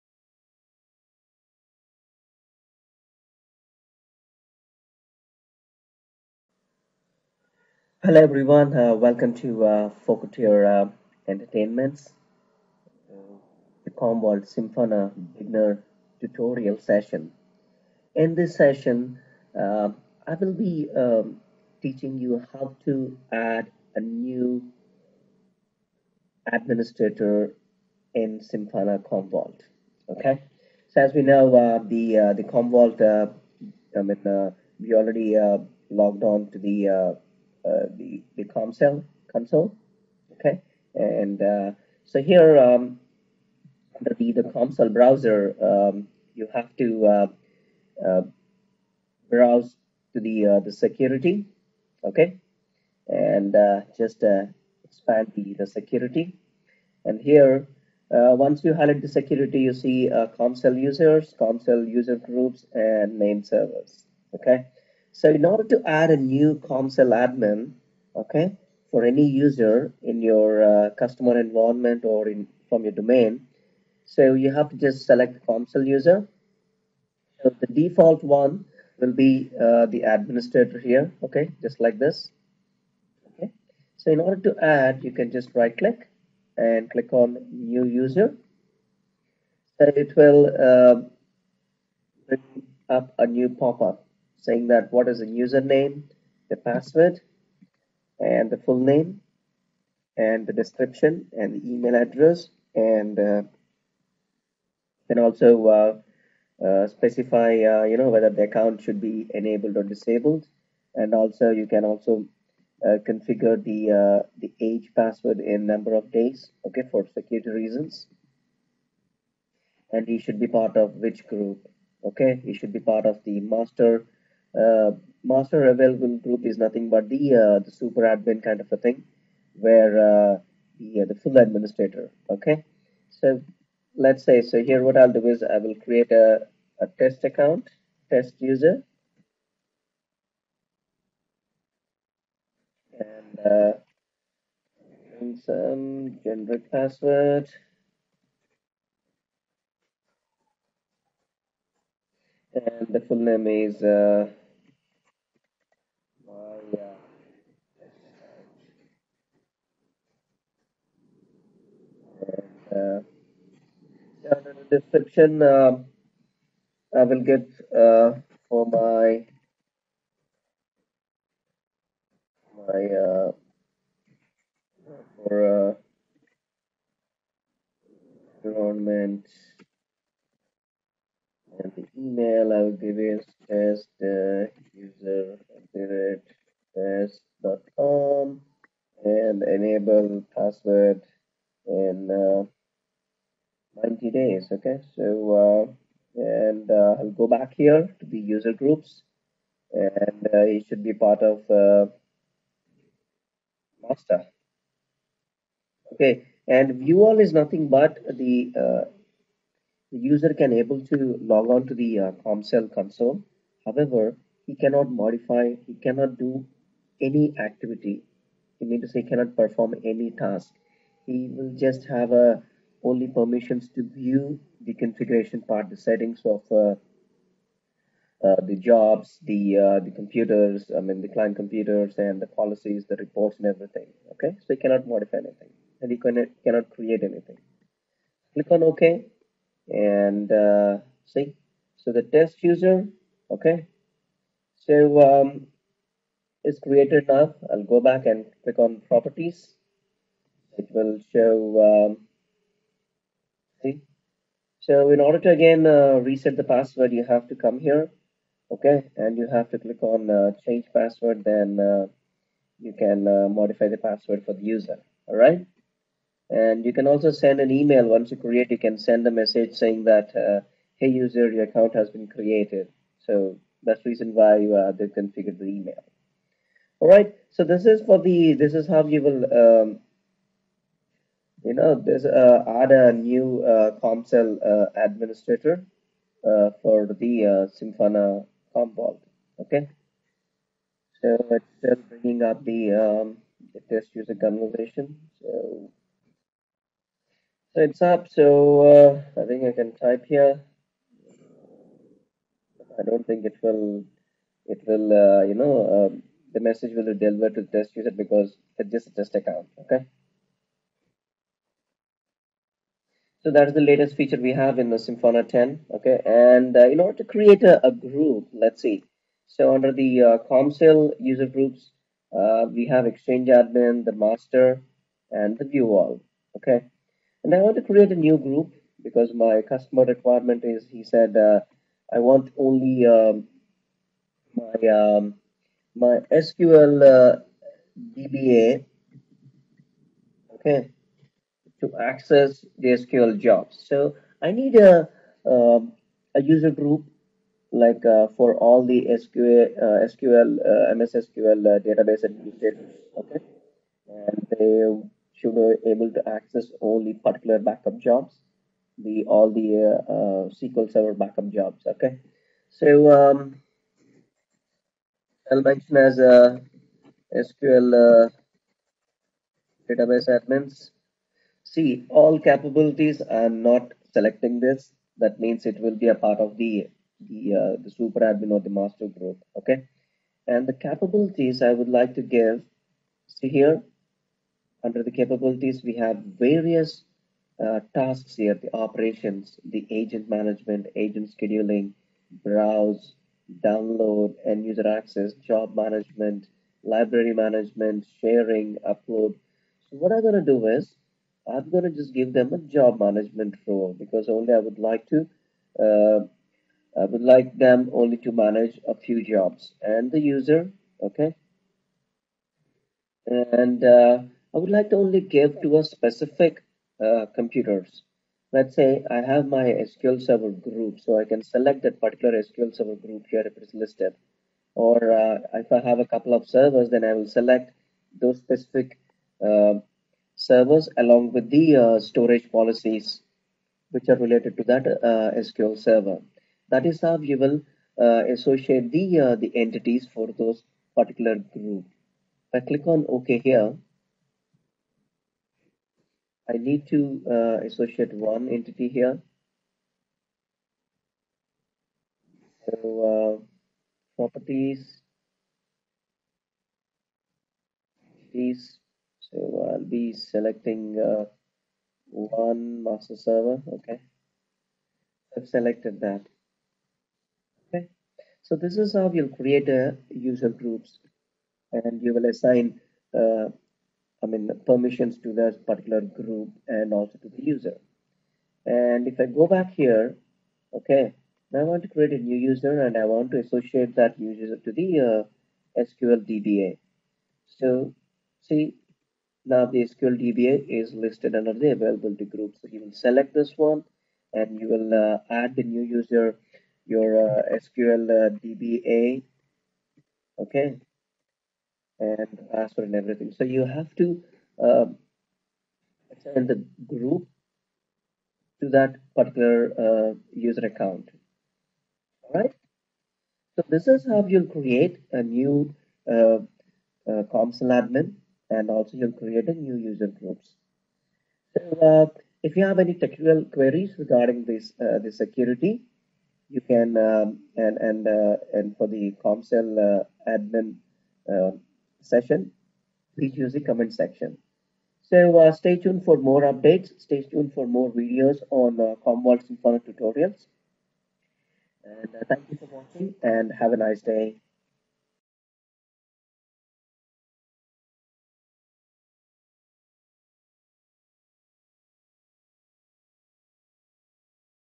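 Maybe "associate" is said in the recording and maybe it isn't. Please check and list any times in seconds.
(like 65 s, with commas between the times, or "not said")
438 s, 447 s, 483 s.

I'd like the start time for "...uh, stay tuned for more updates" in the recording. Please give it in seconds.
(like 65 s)
535 s.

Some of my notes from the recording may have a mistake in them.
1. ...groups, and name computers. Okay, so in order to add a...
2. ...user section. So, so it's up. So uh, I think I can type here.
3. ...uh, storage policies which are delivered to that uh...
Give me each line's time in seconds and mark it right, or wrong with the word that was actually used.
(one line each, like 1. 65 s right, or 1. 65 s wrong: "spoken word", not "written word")
1. 62 s wrong: "servers", not "computers"
2. 293 s wrong: "conversation", not "section"
3. 431 s wrong: "related", not "delivered".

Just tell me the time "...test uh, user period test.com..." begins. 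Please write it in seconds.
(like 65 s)
183 s.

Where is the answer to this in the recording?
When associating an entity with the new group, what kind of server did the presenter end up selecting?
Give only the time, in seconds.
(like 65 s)
462 s.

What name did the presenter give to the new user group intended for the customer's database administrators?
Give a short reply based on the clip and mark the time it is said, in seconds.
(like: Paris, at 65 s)
SQL database admins, at 367 s.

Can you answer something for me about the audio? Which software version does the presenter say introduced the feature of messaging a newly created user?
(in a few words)
Simpana 10.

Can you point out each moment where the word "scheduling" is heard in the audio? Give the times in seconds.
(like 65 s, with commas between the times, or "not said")
391 s.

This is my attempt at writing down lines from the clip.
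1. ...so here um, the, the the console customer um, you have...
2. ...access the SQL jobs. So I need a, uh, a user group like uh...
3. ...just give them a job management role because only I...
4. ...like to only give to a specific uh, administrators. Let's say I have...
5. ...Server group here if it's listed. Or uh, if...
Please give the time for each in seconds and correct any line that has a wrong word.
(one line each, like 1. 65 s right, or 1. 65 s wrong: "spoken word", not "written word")
1. 42 s wrong: "browser", not "customer"
2. 341 s right
3. 401 s right
4. 414 s wrong: "computers", not "administrators"
5. 422 s right.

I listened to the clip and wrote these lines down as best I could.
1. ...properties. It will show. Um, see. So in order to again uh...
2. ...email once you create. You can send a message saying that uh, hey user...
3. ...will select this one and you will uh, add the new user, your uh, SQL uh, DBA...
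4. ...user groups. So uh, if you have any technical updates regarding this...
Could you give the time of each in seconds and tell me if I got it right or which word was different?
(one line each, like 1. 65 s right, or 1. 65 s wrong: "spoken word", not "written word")
1. 248 s right
2. 267 s right
3. 492 s right
4. 519 s wrong: "queries", not "updates".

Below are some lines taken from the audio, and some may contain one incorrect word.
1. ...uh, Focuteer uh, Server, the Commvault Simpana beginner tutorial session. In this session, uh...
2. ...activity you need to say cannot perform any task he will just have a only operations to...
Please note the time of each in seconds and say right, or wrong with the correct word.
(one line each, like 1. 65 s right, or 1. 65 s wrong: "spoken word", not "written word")
1. 9 s wrong: "Entertainments", not "Server"
2. 217 s wrong: "permissions", not "operations".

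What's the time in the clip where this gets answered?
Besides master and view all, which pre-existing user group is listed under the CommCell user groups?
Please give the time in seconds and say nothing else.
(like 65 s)
322 s.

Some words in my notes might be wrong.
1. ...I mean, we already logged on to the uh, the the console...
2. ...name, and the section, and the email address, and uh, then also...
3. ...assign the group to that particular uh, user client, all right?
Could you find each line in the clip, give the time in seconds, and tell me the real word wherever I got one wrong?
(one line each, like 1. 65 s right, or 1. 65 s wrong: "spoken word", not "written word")
1. 33 s right
2. 98 s wrong: "description", not "section"
3. 505 s wrong: "account", not "client".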